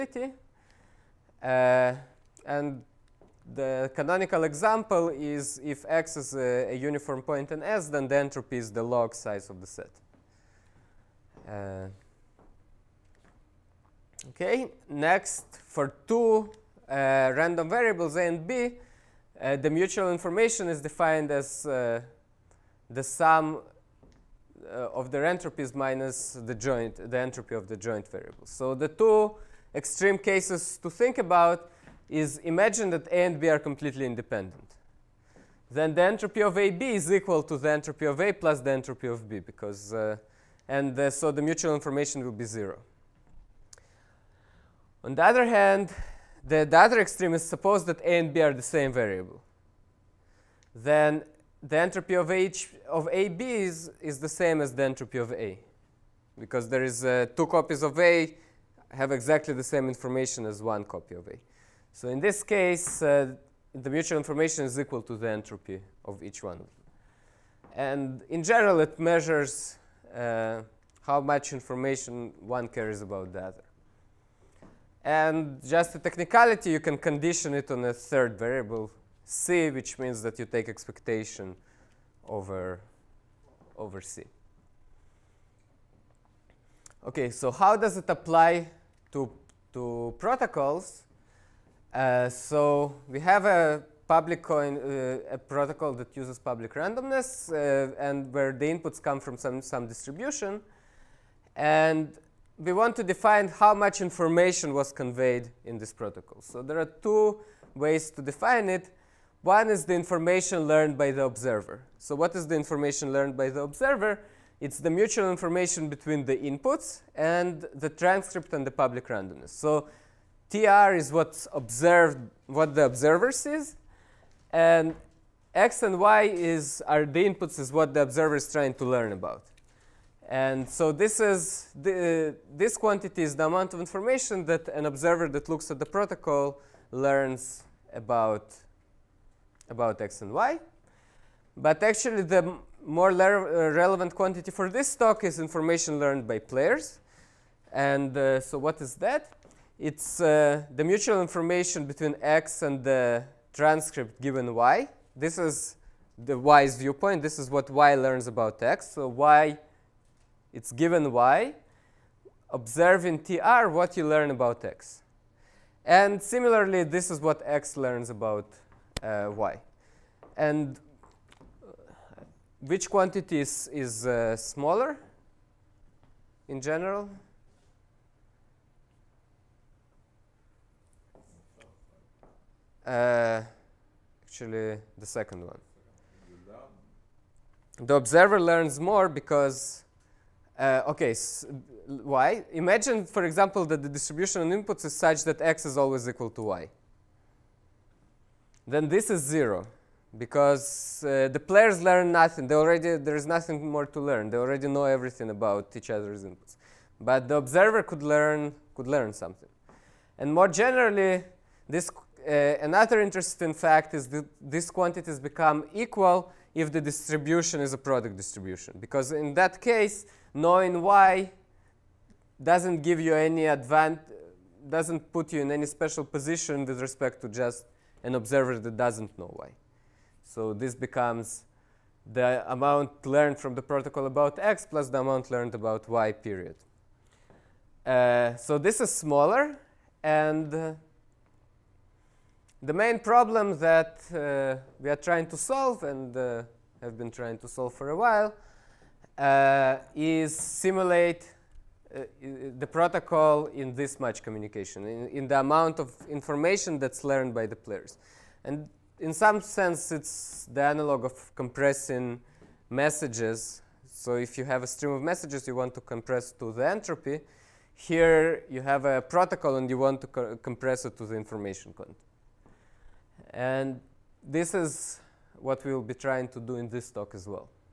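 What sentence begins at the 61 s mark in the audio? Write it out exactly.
So in this case, uh, the mutual information is equal to the entropy of each one.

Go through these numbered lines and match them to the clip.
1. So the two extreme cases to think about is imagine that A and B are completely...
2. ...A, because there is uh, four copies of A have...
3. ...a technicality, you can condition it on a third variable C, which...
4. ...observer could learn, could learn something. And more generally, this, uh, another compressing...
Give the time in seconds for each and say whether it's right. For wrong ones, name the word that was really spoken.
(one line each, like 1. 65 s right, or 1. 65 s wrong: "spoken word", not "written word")
1. 28 s right
2. 55 s wrong: "two", not "four"
3. 75 s right
4. 207 s wrong: "interesting", not "compressing".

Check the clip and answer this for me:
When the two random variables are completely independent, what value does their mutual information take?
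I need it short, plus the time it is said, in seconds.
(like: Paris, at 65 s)
0, at 42 s.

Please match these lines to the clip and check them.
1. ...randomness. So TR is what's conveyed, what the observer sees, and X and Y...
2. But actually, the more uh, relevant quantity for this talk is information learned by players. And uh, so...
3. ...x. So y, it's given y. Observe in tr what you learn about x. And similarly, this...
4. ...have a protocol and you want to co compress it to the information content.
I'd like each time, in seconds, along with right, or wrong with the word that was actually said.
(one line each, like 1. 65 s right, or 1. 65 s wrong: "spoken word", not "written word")
1. 119 s wrong: "observed", not "conveyed"
2. 141 s right
3. 158 s right
4. 268 s right.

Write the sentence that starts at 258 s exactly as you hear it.
And in some sense, it's the analog of compressing messages.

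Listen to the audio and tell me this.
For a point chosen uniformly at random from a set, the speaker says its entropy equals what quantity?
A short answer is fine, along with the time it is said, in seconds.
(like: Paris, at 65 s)
Log size of the set, at 8 s.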